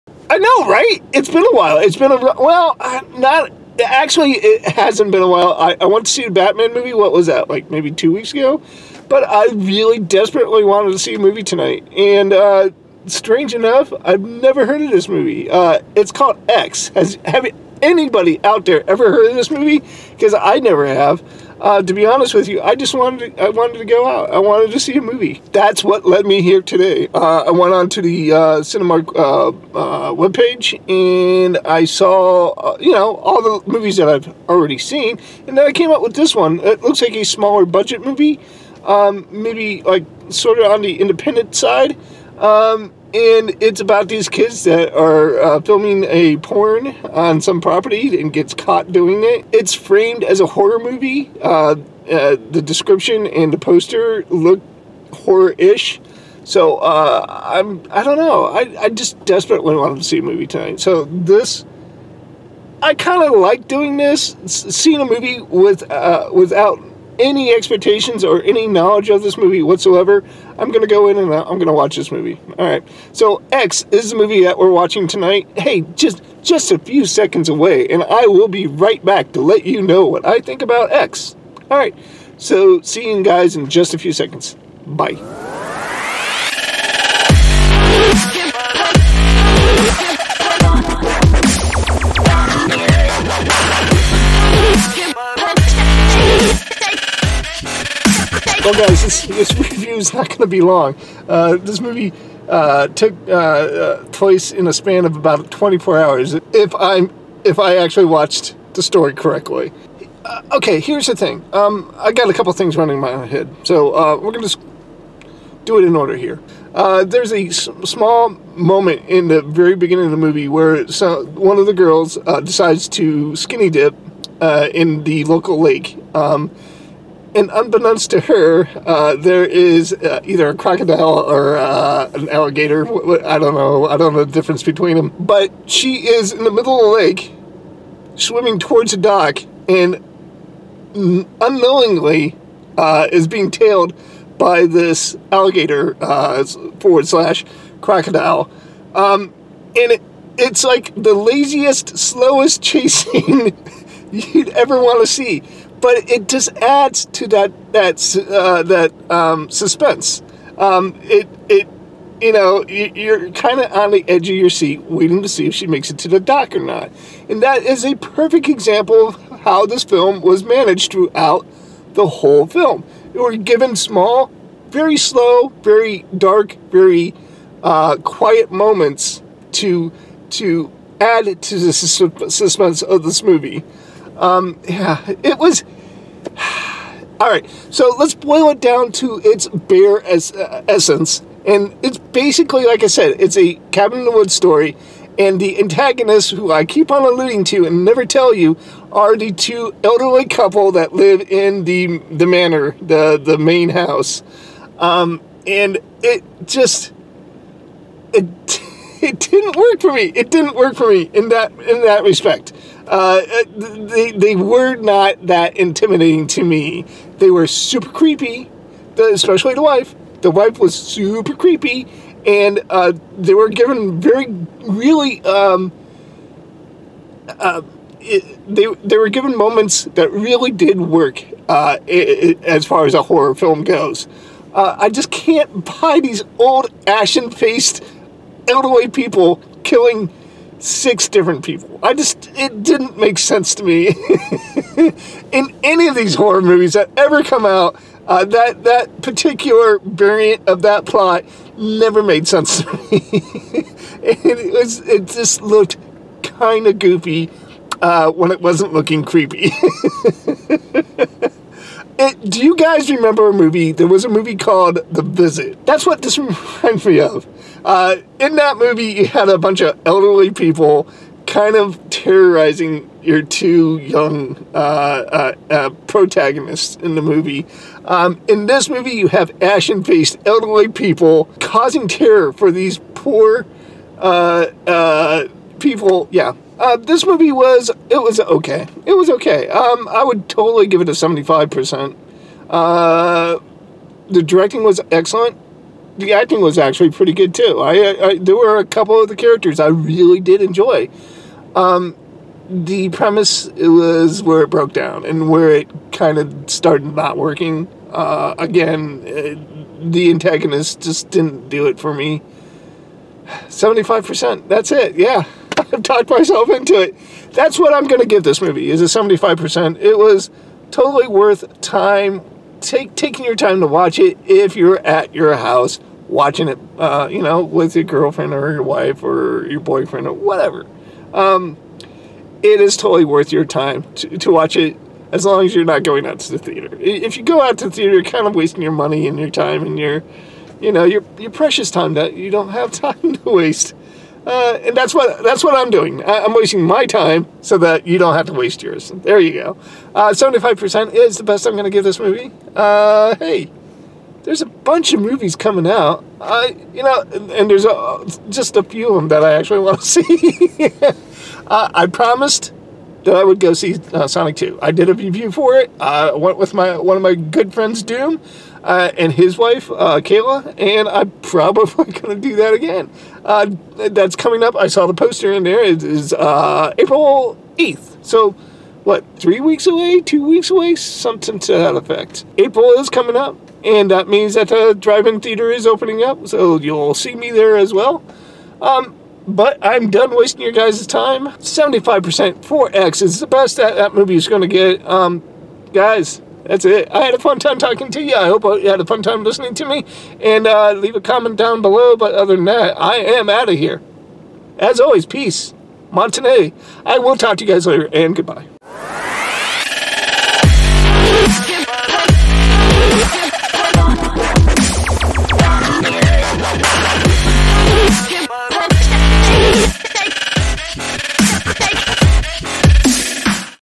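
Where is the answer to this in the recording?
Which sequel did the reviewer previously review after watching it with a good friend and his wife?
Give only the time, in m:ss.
6:04.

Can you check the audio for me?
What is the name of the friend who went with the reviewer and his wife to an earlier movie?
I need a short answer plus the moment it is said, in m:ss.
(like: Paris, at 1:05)
Doom, at 6:07.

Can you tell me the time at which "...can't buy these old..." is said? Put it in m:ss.
3:55.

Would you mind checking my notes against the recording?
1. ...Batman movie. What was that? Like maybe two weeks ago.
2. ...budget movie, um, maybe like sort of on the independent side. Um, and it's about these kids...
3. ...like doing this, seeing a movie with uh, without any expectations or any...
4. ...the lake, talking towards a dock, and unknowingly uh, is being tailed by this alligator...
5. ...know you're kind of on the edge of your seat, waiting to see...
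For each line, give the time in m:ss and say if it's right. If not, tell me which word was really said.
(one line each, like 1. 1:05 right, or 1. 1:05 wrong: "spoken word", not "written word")
1. 0:06 right
2. 0:37 right
3. 1:03 right
4. 2:16 wrong: "swimming", not "talking"
5. 2:42 right.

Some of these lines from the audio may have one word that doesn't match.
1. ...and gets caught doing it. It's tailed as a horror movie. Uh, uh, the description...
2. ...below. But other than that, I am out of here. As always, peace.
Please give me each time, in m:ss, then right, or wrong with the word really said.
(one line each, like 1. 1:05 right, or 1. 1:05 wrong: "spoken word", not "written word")
1. 0:48 wrong: "framed", not "tailed"
2. 6:41 right.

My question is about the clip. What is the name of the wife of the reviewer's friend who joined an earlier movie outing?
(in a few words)
Kayla.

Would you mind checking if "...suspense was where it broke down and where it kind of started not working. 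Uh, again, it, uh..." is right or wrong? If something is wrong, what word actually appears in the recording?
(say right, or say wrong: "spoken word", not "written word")
wrong: "premise", not "suspense".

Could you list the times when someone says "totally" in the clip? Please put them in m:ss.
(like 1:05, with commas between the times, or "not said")
4:50, 5:20, 5:32.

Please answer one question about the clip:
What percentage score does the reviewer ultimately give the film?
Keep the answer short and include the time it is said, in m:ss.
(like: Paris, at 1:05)
75%, at 4:50.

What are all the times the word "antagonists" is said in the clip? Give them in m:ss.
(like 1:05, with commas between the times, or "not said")
3:15, 5:10.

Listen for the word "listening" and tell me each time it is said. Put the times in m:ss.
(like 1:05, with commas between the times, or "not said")
6:39.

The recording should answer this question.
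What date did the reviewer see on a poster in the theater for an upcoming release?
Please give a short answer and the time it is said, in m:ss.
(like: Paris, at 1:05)
April 8th, at 6:16.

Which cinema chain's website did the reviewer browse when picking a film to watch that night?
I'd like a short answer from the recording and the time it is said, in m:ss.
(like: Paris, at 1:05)
Cinemark, at 0:28.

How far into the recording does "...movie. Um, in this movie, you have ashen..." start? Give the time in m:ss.
4:37.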